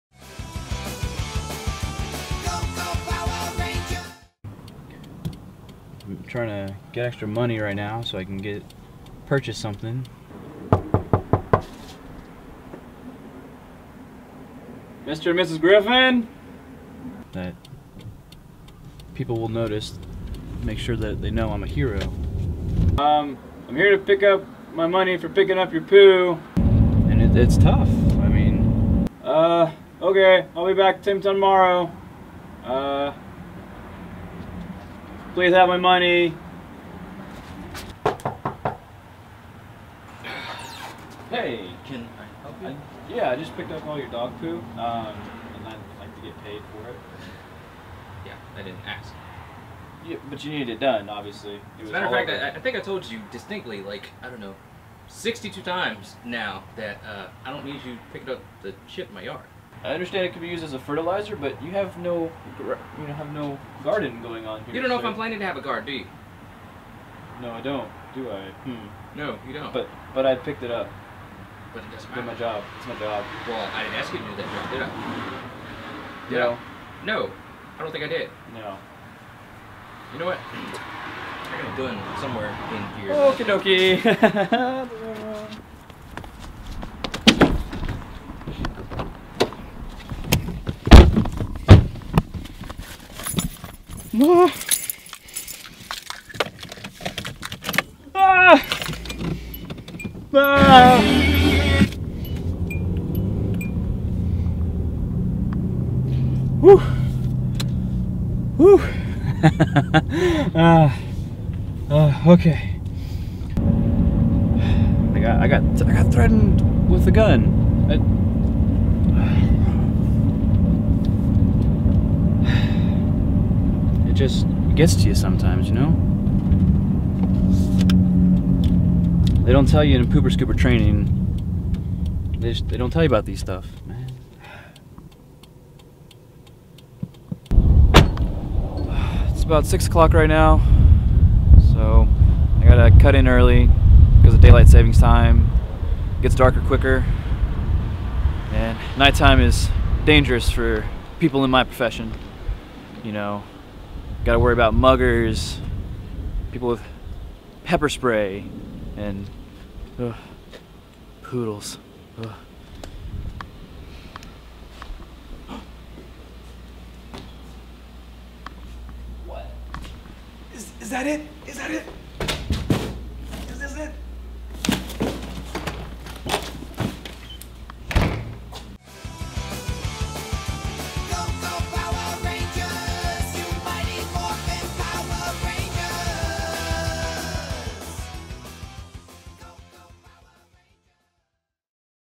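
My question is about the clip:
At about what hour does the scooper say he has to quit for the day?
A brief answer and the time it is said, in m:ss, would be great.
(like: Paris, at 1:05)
6 o'clock, at 2:19.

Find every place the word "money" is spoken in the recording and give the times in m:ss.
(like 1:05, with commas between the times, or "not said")
0:07, 0:24, 0:35.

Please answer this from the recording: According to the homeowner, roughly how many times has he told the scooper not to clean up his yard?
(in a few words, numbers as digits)
62.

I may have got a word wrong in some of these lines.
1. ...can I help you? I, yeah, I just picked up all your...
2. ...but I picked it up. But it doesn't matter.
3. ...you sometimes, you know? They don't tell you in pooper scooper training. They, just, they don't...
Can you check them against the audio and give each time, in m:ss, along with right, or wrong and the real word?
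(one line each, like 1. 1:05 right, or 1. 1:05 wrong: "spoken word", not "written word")
1. 0:41 right
2. 1:10 right
3. 2:05 right.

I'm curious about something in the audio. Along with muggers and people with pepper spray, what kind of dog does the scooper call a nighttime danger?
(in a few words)
Poodles.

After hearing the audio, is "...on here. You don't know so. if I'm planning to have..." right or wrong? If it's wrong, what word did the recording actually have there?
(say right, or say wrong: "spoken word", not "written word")
right.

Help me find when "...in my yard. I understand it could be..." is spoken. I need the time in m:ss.
0:59.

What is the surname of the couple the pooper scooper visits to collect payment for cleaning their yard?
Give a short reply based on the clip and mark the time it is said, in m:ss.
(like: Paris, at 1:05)
Griffin, at 0:15.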